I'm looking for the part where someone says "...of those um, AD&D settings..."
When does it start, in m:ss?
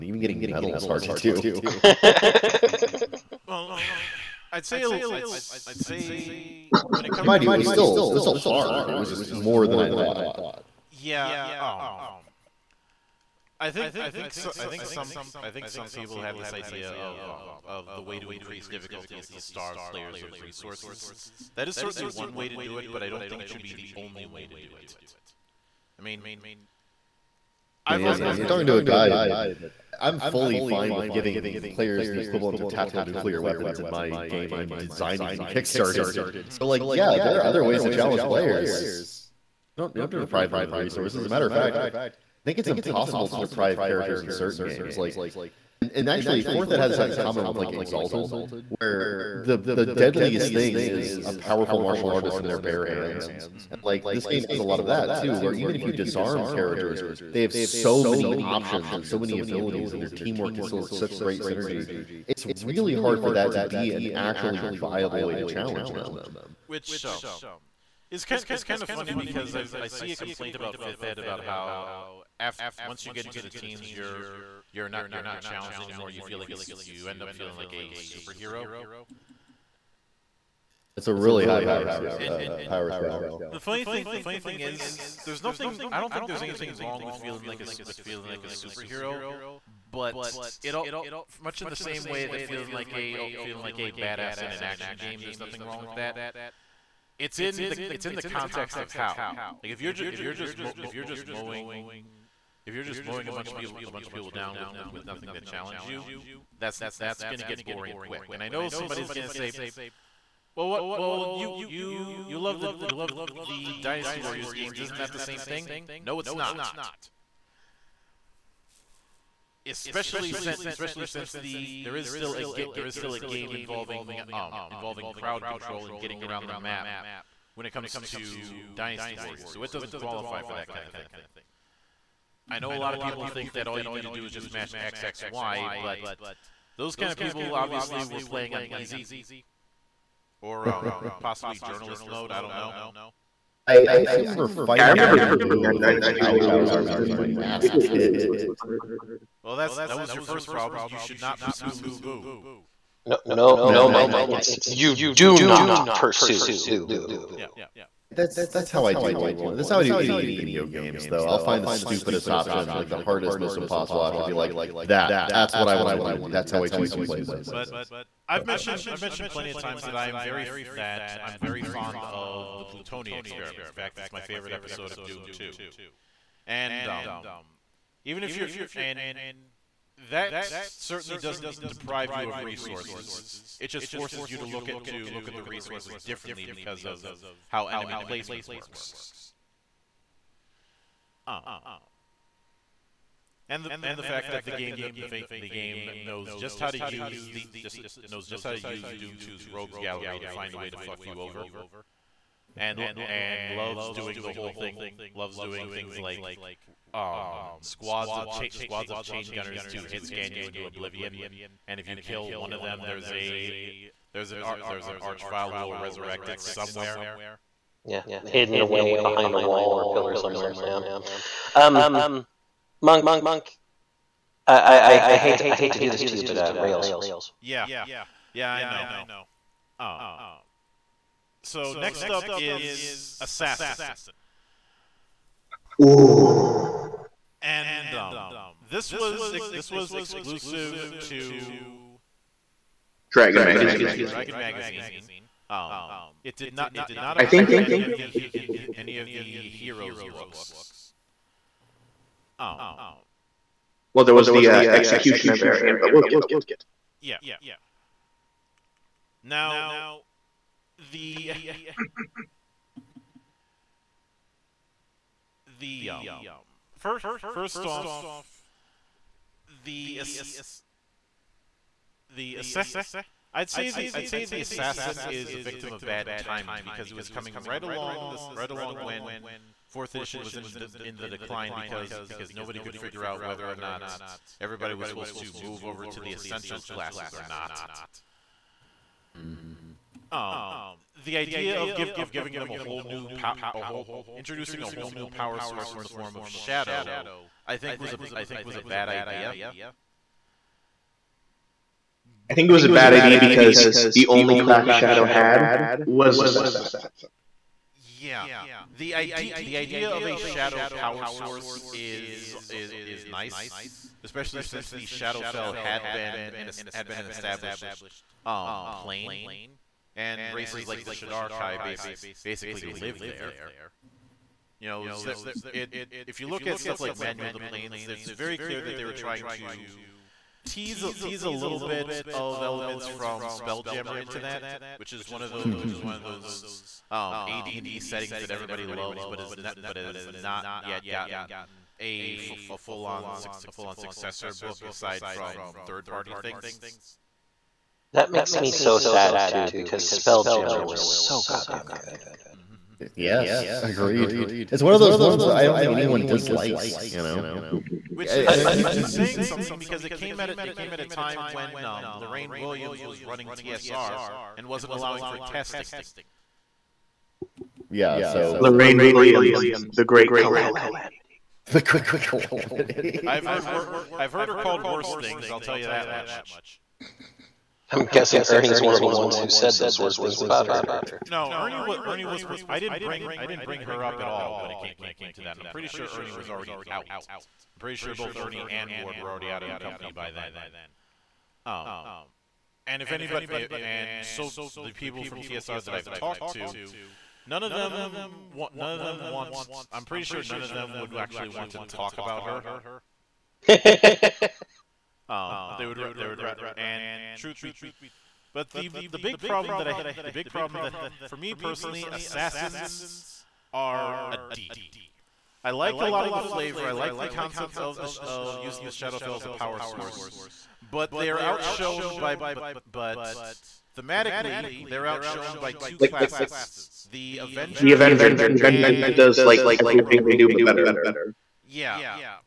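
5:35.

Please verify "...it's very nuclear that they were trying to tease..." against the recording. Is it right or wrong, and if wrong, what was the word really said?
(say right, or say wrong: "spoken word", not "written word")
wrong: "clear", not "nuclear".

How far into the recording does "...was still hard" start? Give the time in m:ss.
0:08.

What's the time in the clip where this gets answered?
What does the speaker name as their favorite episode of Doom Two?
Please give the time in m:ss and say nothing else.
2:52.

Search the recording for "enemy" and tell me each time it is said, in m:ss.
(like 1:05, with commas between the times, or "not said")
3:07.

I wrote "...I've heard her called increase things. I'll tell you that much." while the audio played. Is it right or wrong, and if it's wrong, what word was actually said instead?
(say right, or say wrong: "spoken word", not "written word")
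wrong: "worse", not "increase".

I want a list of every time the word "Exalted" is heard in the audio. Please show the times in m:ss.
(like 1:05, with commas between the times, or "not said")
0:47.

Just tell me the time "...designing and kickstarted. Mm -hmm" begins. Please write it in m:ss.
0:34.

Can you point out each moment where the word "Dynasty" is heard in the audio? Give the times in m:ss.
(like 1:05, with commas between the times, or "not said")
1:53, 2:08.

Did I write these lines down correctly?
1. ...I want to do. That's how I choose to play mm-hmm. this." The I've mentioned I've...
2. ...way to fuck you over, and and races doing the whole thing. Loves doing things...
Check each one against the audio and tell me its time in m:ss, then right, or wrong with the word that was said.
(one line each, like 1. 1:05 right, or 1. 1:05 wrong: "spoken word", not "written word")
1. 2:45 wrong: "But", not "The"
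2. 3:20 wrong: "loves", not "races".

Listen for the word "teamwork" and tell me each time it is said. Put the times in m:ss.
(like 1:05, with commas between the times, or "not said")
1:00.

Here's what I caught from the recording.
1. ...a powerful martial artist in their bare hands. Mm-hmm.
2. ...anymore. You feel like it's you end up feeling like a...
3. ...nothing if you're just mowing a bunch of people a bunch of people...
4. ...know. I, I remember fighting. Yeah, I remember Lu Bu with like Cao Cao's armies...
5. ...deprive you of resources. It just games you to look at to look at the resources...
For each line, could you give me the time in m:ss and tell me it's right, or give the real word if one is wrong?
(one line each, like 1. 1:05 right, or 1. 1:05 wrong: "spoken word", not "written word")
1. 0:51 right
2. 1:15 right
3. 1:41 wrong: "mowing", not "nothing"
4. 2:22 right
5. 3:01 wrong: "forces", not "games".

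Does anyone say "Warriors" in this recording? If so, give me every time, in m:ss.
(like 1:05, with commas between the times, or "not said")
1:54, 2:09.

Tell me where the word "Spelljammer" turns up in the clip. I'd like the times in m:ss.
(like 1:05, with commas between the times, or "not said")
5:33, 5:49.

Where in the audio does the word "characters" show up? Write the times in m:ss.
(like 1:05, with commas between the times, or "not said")
0:43, 0:56.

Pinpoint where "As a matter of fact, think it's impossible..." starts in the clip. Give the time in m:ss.
0:41.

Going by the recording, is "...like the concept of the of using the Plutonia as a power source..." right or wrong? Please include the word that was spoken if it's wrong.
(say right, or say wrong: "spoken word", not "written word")
wrong: "Shadowfell", not "Plutonia".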